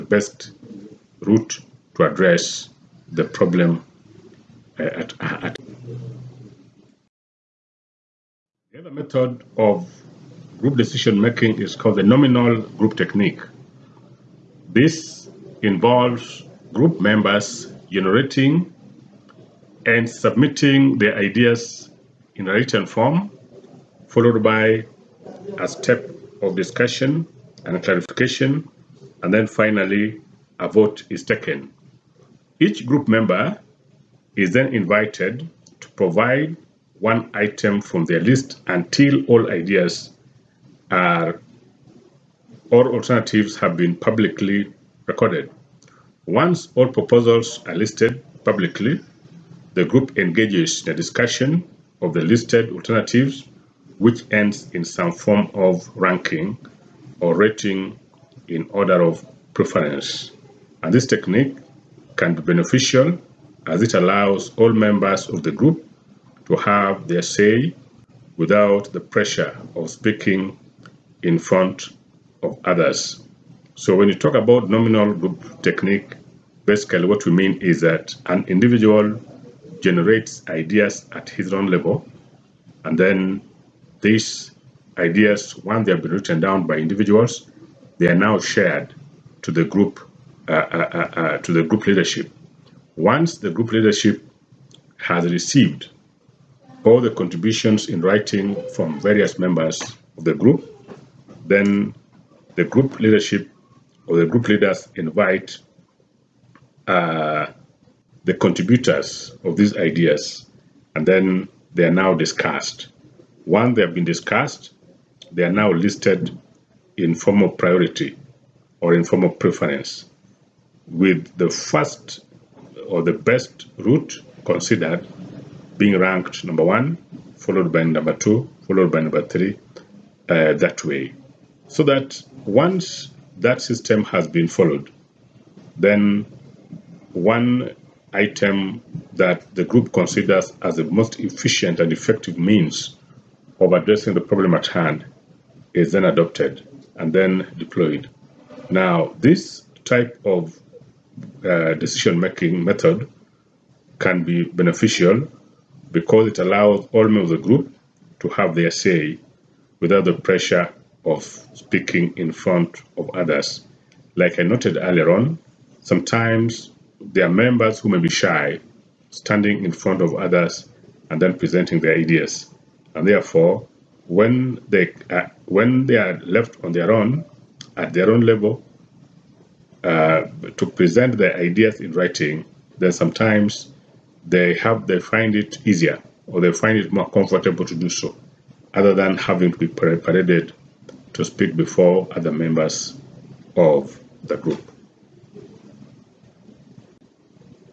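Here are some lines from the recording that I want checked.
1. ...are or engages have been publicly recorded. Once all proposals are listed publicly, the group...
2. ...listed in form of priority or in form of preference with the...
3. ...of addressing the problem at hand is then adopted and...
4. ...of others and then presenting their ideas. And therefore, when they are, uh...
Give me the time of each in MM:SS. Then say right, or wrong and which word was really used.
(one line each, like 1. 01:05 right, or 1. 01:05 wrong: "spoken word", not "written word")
1. 00:40 wrong: "alternatives", not "engages"
2. 01:55 right
3. 02:23 right
4. 02:50 right.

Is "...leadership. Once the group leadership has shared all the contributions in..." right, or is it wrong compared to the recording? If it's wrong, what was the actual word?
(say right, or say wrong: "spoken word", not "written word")
wrong: "received", not "shared".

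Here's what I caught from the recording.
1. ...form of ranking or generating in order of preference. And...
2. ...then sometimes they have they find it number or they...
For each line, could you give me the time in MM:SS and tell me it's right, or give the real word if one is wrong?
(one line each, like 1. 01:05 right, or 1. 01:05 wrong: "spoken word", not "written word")
1. 00:55 wrong: "rating", not "generating"
2. 03:02 wrong: "easier", not "number".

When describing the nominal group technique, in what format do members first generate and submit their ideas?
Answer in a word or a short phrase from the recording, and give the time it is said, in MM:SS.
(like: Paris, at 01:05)
Written form, at 00:22.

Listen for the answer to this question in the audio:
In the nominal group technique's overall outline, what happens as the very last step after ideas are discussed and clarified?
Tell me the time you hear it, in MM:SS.
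00:30.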